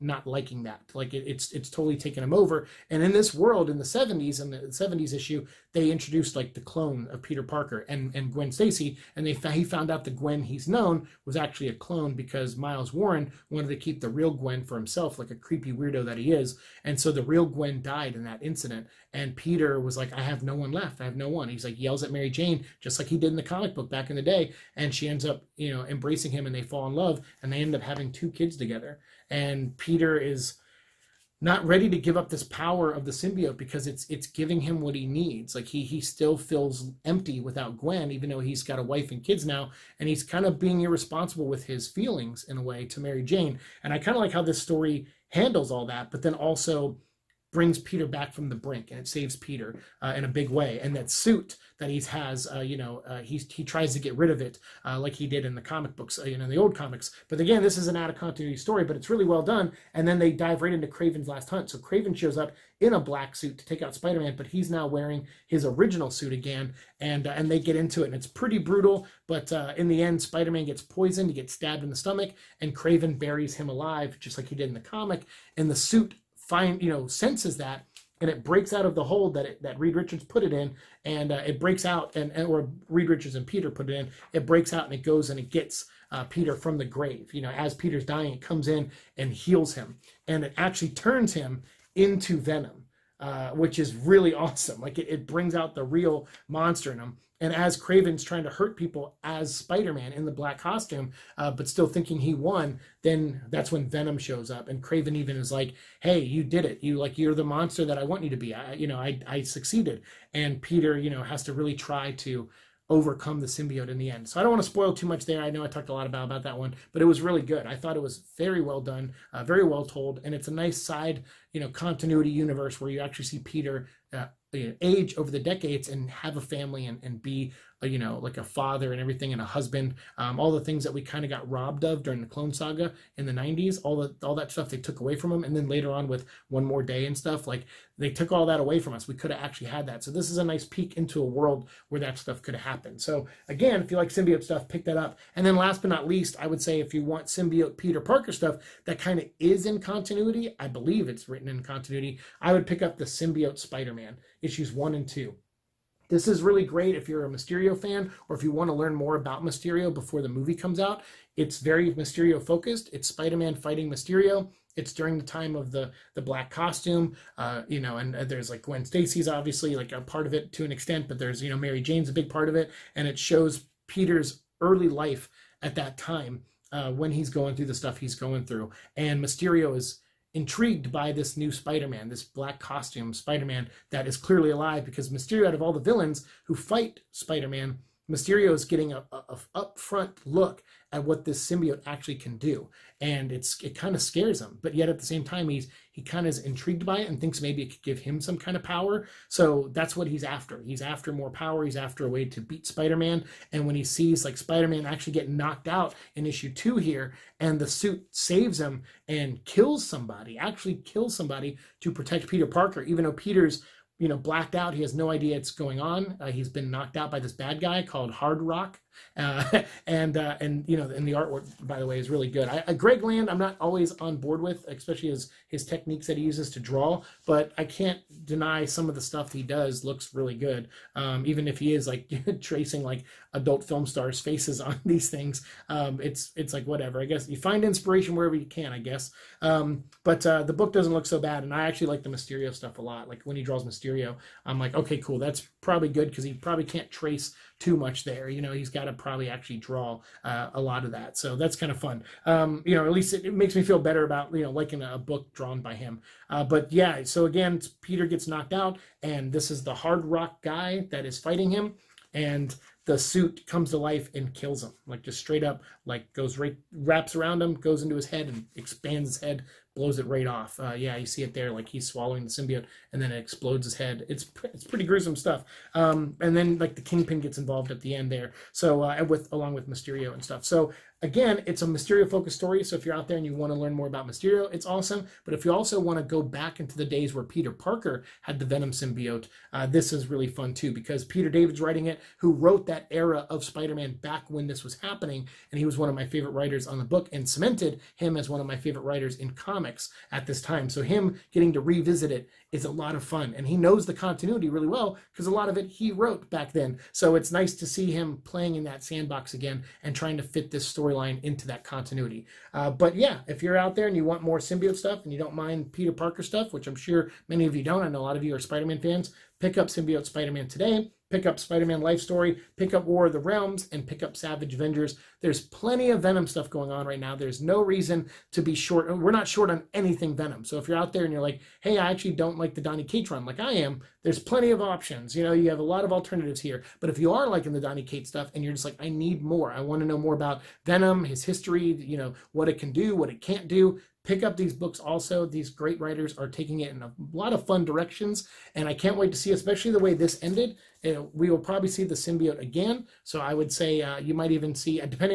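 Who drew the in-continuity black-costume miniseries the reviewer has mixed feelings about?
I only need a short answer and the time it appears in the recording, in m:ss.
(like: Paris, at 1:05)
Greg Land, at 3:42.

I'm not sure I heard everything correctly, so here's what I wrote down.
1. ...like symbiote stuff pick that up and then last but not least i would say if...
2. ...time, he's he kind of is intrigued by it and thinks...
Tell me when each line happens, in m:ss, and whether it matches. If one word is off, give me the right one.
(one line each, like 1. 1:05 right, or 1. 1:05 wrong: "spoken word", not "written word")
1. 2:23 right
2. 3:15 right.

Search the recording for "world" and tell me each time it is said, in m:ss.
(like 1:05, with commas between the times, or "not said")
0:03, 2:21.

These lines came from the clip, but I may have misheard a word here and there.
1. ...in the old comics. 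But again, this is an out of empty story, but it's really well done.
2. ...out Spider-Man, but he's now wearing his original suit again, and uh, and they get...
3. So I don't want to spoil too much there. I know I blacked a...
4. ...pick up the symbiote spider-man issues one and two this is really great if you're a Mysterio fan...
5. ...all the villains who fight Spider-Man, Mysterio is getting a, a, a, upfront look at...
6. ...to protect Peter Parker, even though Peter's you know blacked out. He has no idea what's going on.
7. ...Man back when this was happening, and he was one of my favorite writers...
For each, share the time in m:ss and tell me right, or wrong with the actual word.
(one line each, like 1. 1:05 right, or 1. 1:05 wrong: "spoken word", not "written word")
1. 0:56 wrong: "continuity", not "empty"
2. 1:03 right
3. 1:54 wrong: "talked", not "blacked"
4. 2:32 right
5. 3:05 right
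6. 3:31 right
7. 4:53 right.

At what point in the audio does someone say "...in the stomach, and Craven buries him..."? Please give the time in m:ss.
1:11.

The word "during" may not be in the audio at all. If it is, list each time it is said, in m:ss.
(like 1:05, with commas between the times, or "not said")
2:12, 2:44.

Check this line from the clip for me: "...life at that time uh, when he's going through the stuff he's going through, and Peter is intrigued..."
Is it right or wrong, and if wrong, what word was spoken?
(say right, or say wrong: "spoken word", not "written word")
wrong: "Mysterio", not "Peter".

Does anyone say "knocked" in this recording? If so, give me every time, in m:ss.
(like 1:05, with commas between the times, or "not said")
3:25, 3:36, 4:18.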